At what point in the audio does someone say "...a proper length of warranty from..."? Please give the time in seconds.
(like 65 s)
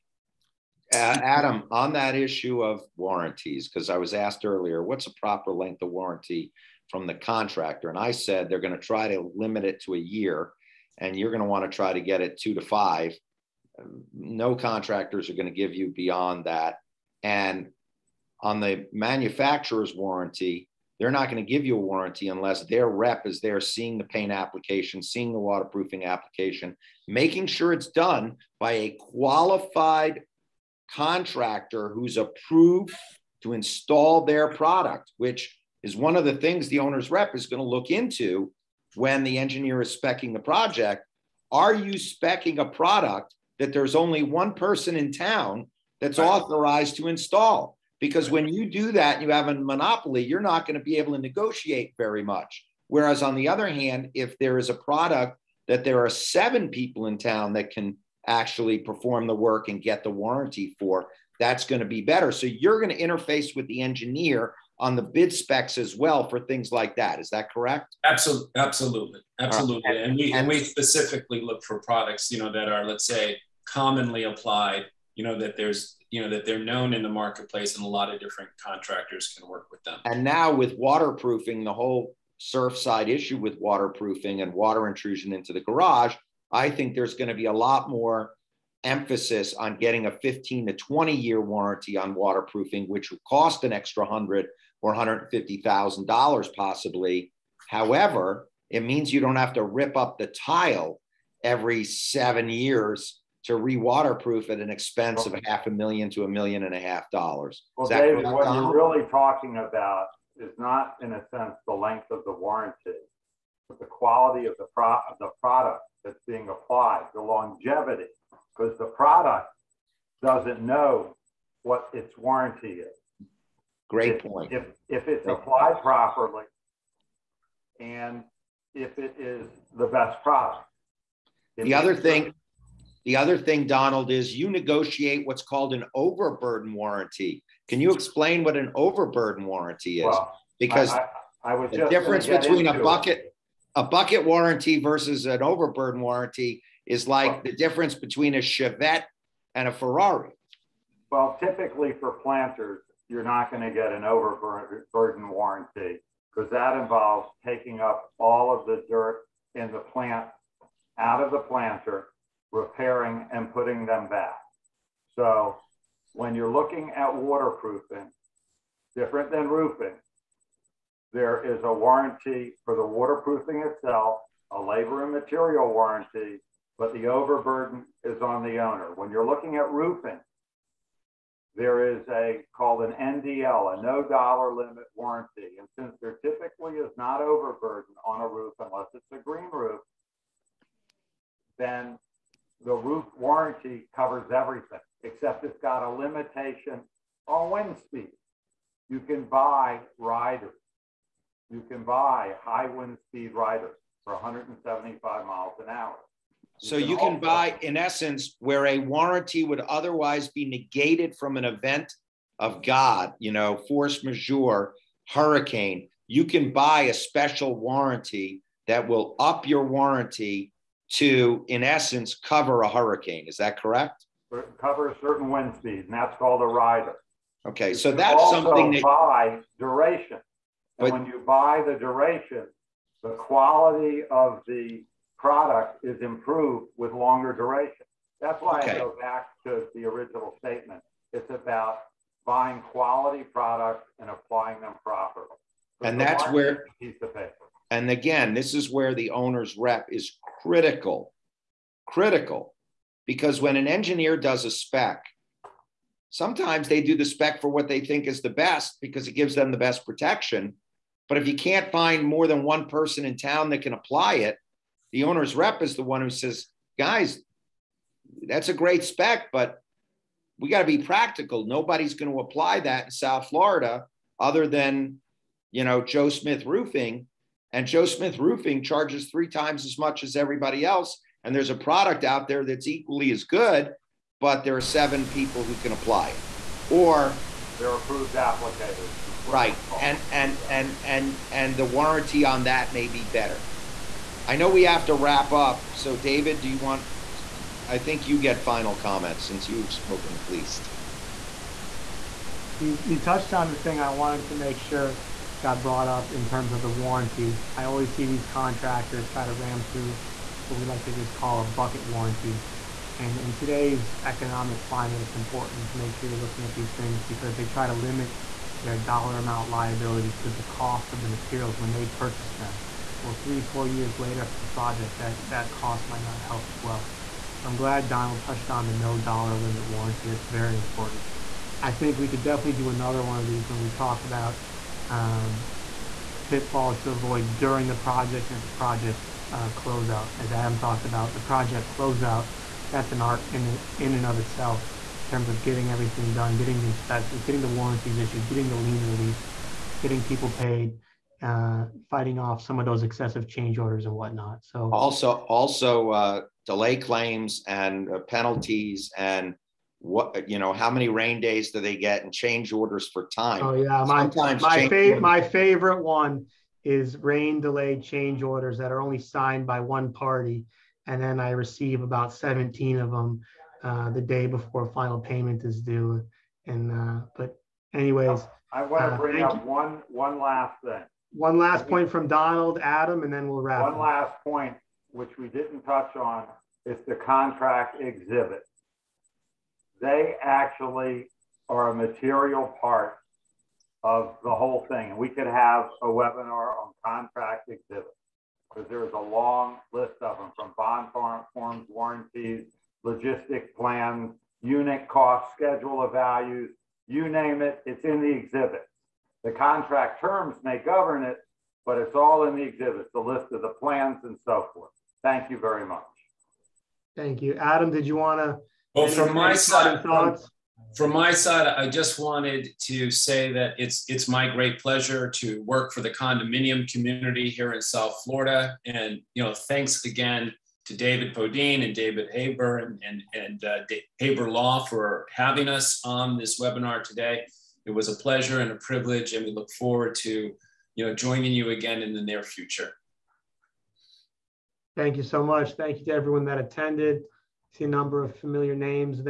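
5 s.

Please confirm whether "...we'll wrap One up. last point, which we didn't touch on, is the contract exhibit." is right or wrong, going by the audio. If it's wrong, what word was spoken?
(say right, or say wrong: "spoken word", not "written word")
right.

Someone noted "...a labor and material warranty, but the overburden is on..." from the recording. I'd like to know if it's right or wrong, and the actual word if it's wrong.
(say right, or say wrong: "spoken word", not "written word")
right.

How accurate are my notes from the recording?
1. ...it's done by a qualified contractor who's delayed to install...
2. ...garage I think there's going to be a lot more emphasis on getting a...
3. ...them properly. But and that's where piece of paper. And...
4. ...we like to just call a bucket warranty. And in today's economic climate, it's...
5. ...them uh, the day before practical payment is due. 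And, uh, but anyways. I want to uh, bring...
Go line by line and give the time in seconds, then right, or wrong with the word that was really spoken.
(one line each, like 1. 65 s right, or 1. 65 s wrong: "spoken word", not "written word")
1. 27 s wrong: "approved", not "delayed"
2. 85 s right
3. 244 s right
4. 310 s right
5. 372 s wrong: "final", not "practical".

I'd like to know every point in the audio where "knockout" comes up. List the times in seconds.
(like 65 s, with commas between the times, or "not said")
not said.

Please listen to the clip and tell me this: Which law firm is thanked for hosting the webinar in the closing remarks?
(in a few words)
Haber Law.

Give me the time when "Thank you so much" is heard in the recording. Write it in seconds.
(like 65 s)
444 s.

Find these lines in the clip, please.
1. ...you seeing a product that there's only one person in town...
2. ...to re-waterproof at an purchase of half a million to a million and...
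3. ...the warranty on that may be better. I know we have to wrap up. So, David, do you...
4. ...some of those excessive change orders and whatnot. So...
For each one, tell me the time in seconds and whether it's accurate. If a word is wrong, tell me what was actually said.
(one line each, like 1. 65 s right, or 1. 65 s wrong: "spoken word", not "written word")
1. 41 s wrong: "specing", not "seeing"
2. 103 s wrong: "expense", not "purchase"
3. 291 s right
4. 352 s right.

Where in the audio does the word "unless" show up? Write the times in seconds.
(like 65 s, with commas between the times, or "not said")
22 s, 188 s.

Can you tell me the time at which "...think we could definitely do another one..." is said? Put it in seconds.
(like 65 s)
331 s.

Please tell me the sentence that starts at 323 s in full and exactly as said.
Well, three, four years later after the project, that, that cost might not help as well.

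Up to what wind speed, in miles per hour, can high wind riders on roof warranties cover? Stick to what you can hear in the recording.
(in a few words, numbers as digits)
175.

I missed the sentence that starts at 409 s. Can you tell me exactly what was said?
The contract terms may govern it, but it's all in the exhibits, the list of the plans and so forth.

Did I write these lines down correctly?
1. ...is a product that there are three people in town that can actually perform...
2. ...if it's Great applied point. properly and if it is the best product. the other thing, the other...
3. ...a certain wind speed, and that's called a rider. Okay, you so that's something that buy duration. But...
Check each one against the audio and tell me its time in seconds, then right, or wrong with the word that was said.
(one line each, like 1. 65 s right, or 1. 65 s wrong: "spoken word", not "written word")
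1. 54 s wrong: "seven", not "three"
2. 124 s right
3. 224 s right.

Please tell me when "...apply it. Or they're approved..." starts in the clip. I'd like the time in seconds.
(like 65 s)
285 s.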